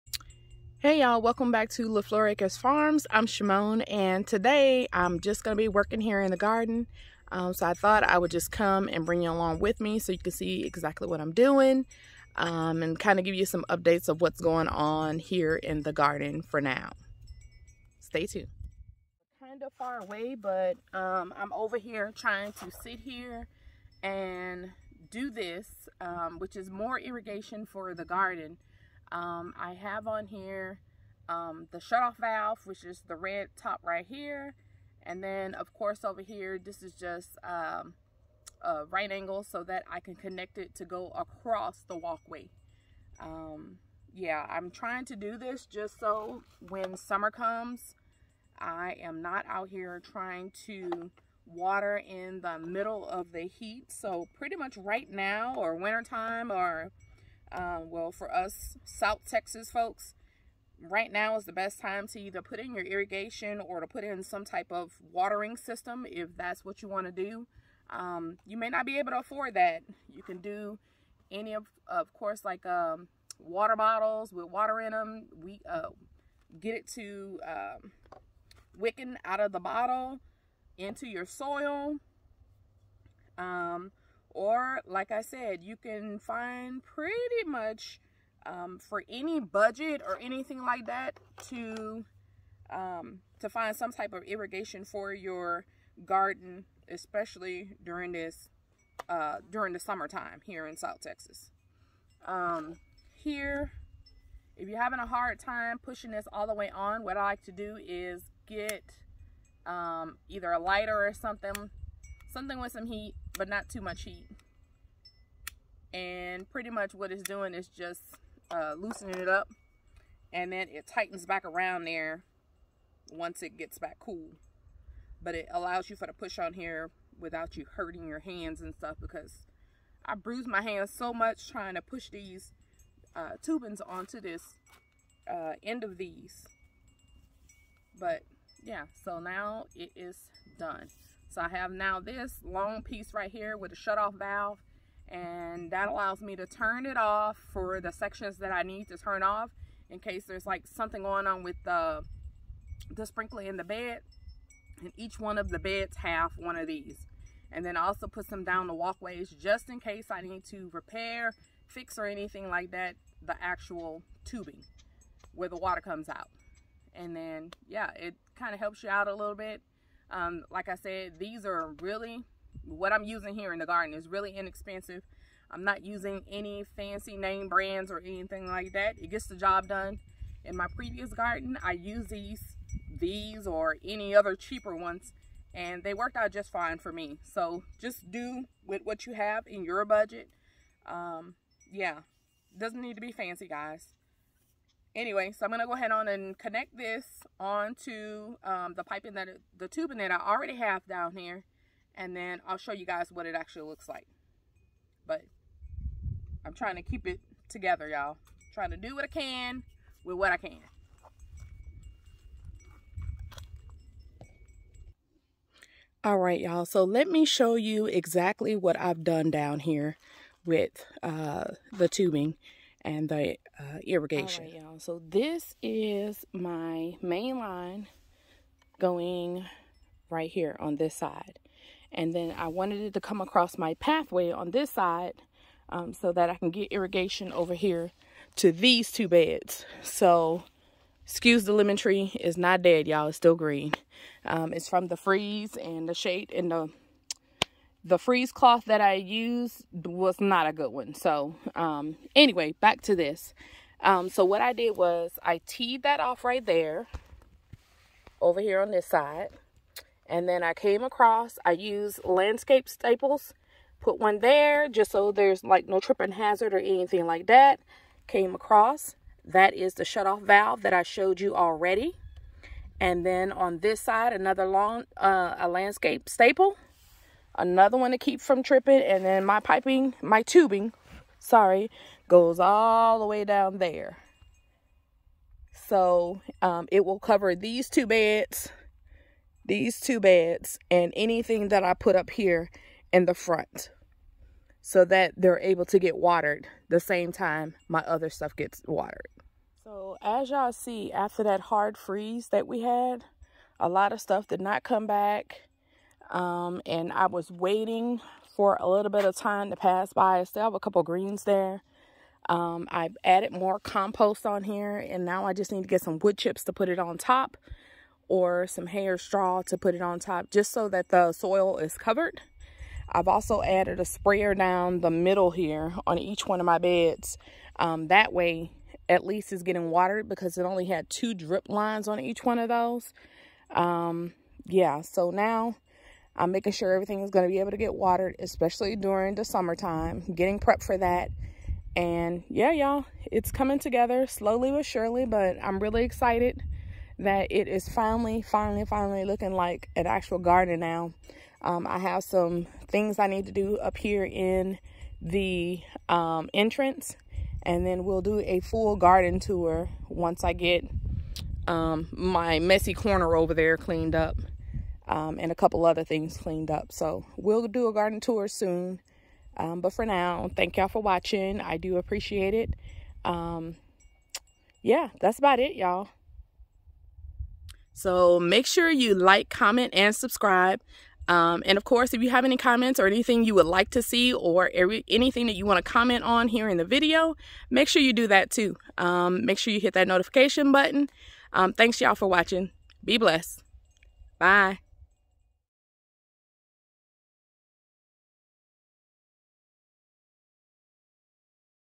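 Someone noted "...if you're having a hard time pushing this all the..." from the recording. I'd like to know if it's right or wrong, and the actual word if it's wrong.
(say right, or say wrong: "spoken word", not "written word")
right.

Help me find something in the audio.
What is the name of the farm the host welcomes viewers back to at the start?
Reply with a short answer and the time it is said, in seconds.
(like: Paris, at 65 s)
LeFleur Acres Farms, at 1 s.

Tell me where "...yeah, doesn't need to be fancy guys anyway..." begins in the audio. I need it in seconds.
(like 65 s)
191 s.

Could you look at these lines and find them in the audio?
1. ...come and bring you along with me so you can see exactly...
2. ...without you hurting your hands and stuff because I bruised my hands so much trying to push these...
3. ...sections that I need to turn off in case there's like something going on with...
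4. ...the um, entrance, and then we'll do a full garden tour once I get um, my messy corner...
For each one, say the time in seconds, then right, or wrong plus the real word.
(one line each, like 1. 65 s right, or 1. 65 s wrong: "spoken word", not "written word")
1. 8 s right
2. 127 s right
3. 147 s right
4. 355 s right.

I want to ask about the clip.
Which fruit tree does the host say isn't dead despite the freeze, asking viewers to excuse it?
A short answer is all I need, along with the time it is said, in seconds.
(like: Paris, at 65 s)
Lemon tree, at 241 s.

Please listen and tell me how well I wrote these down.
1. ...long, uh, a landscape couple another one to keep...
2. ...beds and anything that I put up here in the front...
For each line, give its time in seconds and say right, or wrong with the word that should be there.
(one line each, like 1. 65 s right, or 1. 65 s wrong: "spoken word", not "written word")
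1. 274 s wrong: "staple", not "couple"
2. 289 s right.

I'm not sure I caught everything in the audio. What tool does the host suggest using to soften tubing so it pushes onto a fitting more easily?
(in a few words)
A lighter.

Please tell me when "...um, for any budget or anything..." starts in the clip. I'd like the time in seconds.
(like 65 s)
88 s.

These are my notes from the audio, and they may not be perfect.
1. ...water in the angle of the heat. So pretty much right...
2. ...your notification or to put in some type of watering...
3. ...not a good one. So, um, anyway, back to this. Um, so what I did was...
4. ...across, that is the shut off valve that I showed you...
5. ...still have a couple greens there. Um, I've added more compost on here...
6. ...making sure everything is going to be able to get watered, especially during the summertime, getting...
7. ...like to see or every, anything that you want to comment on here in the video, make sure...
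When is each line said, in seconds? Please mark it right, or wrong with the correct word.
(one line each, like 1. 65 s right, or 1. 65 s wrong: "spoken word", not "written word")
1. 51 s wrong: "middle", not "angle"
2. 62 s wrong: "irrigation", not "notification"
3. 250 s right
4. 268 s right
5. 310 s right
6. 336 s right
7. 383 s right.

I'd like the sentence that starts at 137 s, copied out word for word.
But yeah, so now it is done.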